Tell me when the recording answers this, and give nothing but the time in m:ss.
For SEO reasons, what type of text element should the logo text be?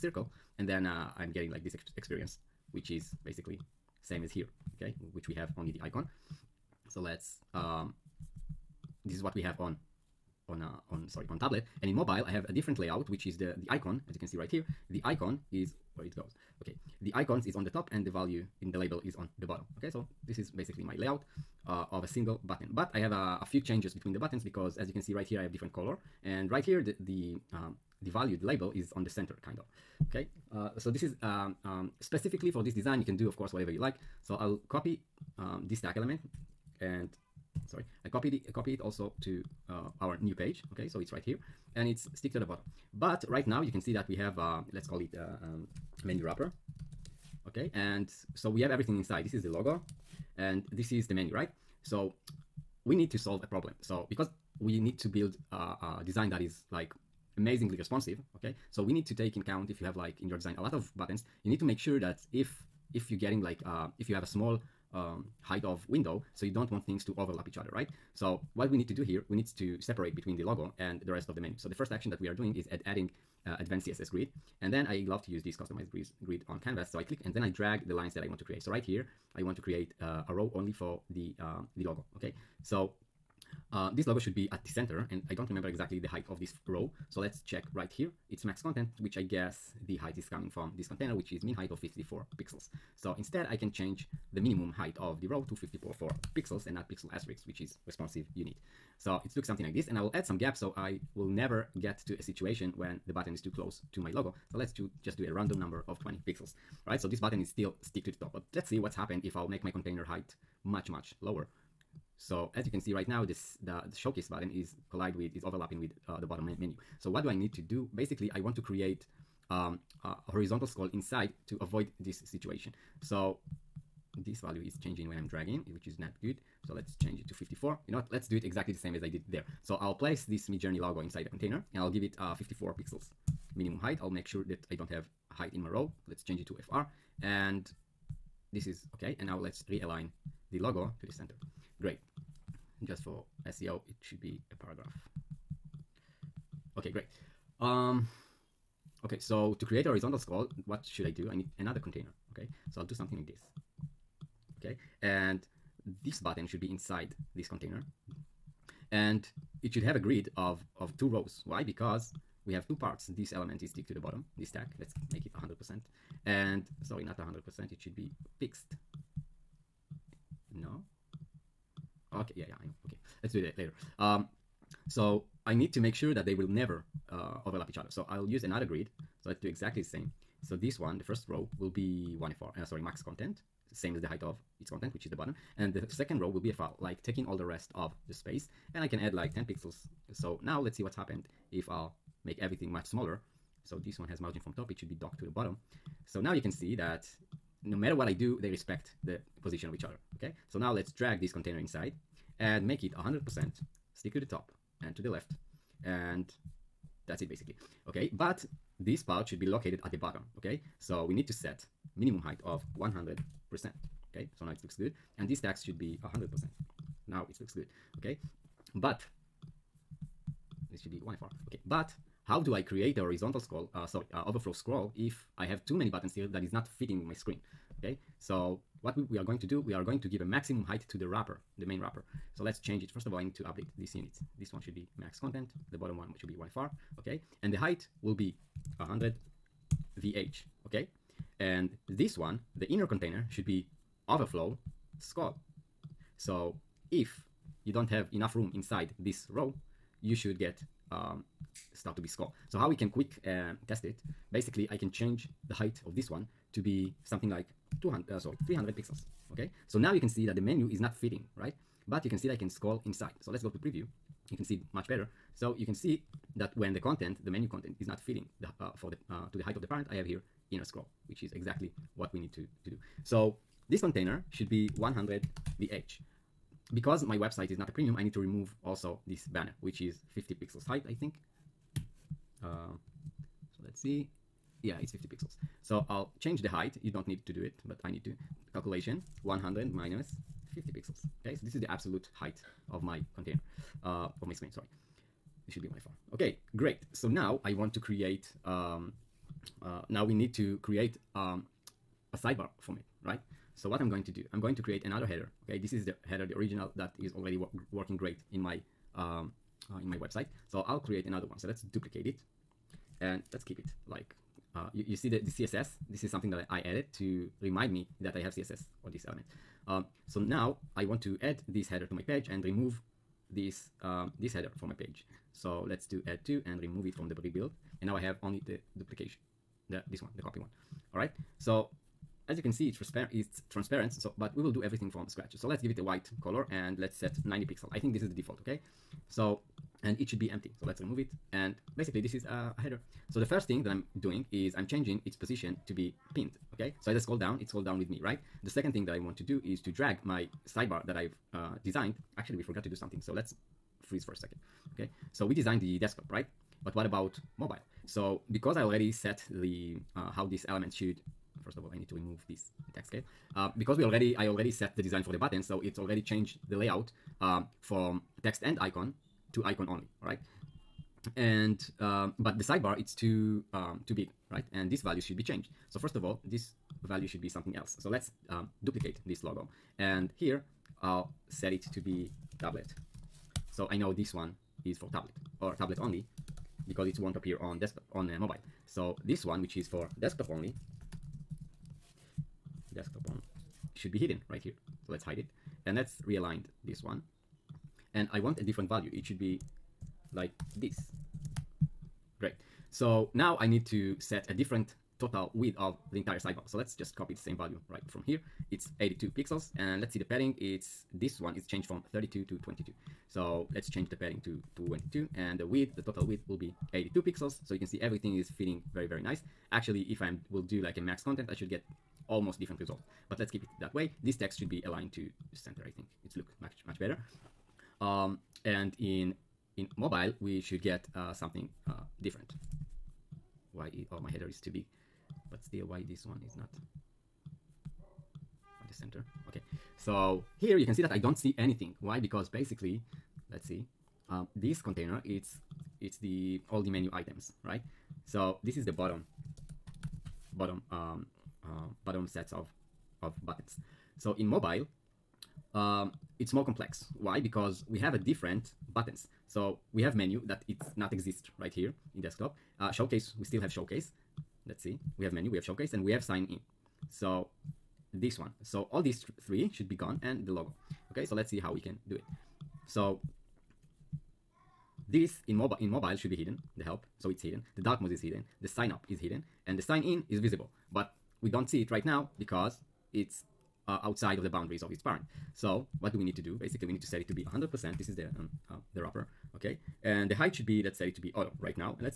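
2:24.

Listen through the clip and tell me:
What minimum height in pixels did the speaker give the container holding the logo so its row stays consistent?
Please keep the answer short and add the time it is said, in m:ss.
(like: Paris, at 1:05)
54 pixels, at 2:12.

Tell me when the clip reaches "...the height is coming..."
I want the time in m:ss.
1:29.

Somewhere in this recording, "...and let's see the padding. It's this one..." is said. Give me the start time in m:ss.
6:49.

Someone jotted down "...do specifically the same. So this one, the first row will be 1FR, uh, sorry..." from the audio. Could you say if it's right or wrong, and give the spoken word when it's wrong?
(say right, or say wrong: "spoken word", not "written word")
wrong: "exactly", not "specifically".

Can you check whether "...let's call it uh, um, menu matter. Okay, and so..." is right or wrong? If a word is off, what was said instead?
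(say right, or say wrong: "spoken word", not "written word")
wrong: "wrapper", not "matter".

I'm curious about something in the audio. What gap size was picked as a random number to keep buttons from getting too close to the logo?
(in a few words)
20 pixels.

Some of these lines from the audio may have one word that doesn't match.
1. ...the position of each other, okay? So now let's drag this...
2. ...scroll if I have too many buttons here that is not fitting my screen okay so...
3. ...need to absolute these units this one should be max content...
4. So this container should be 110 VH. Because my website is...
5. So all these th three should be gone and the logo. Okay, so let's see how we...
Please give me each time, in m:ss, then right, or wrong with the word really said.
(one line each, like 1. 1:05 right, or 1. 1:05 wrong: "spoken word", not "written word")
1. 3:19 right
2. 3:44 right
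3. 3:53 wrong: "update", not "absolute"
4. 4:33 wrong: "100", not "110"
5. 7:48 right.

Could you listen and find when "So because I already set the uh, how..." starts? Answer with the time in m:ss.
5:57.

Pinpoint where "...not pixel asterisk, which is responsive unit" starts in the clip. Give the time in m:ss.
1:36.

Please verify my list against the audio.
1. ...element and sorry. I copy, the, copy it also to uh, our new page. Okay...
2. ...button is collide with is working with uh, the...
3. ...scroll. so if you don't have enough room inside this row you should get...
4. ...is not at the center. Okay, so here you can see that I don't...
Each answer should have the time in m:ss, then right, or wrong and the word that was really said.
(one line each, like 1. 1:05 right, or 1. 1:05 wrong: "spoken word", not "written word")
1. 0:35 right
2. 1:54 wrong: "overlapping", not "working"
3. 4:04 right
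4. 7:16 right.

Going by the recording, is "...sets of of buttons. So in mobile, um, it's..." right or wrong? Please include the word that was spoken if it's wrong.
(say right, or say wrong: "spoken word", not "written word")
right.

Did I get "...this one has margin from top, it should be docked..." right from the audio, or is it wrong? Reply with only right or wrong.
right.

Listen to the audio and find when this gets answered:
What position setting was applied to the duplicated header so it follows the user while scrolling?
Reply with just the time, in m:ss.
5:46.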